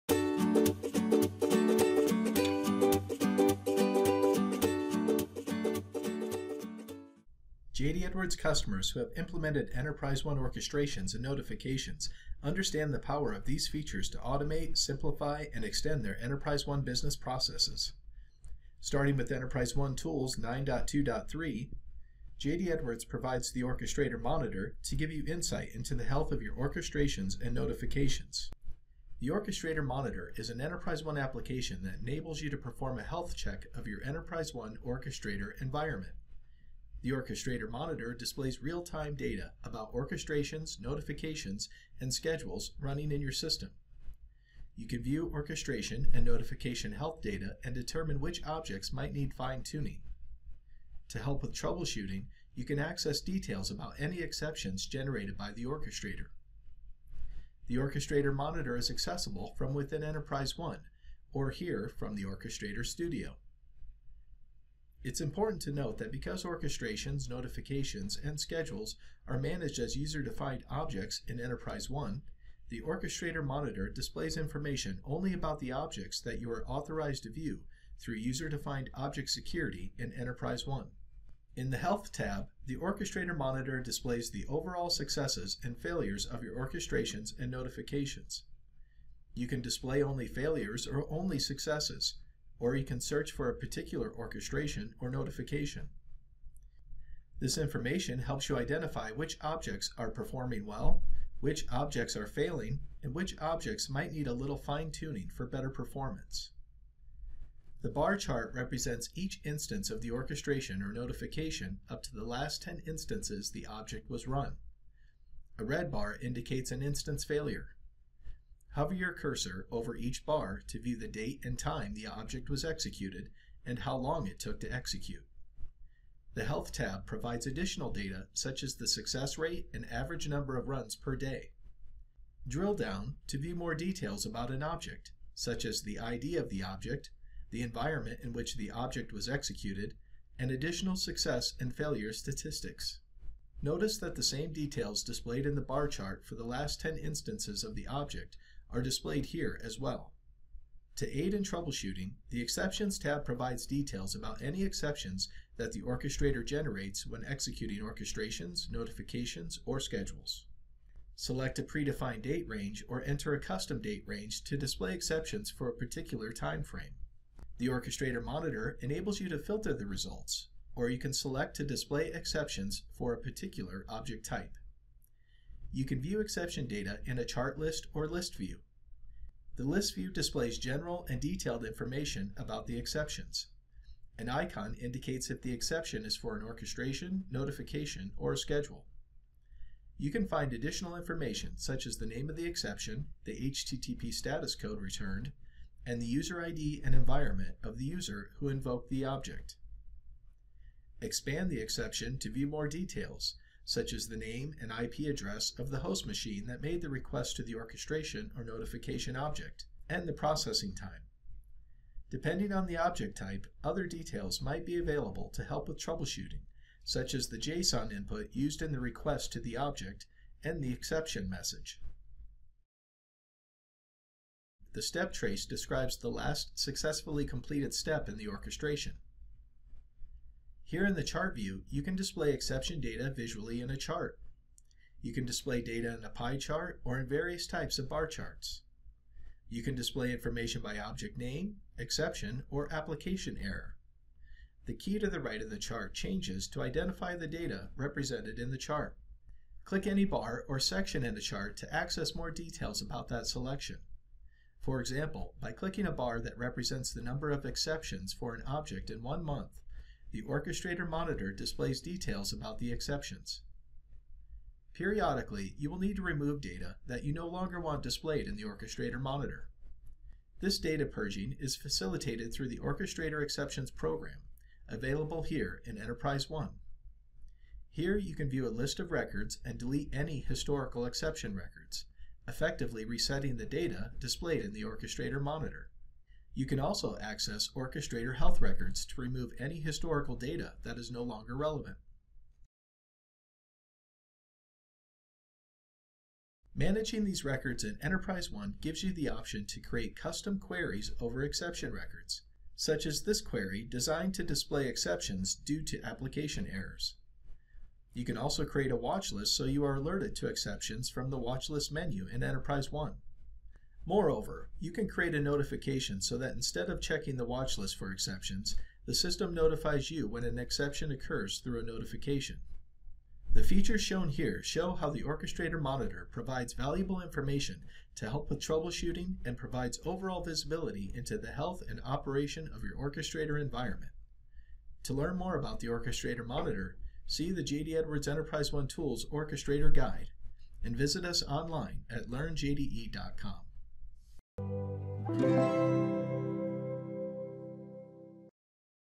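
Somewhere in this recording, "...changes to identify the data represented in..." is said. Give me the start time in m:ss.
4:05.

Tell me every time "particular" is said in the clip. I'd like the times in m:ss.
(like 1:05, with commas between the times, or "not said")
1:33, 2:45, 2:53.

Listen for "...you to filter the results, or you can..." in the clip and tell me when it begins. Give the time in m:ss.
2:49.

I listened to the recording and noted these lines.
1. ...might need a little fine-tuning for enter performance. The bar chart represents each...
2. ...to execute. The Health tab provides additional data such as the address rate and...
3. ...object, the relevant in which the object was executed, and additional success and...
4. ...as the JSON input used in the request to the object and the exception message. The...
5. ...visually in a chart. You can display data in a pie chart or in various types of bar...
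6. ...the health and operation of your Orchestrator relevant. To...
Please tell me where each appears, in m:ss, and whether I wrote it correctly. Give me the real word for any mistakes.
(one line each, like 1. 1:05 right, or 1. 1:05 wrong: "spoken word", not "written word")
1. 1:43 wrong: "better", not "enter"
2. 2:04 wrong: "success", not "address"
3. 2:16 wrong: "environment", not "relevant"
4. 3:37 right
5. 3:53 right
6. 5:31 wrong: "environment", not "relevant".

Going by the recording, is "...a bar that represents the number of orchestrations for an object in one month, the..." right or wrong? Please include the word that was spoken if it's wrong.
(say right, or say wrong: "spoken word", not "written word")
wrong: "exceptions", not "orchestrations".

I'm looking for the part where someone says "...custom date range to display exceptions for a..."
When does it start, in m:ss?
2:43.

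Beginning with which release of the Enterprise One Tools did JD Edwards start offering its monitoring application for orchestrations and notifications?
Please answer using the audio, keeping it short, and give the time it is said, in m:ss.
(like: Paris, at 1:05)
9.2.3, at 0:20.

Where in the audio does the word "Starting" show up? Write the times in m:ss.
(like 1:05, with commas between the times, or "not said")
0:18.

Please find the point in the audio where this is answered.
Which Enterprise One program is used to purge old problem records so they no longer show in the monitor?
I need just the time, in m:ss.
4:32.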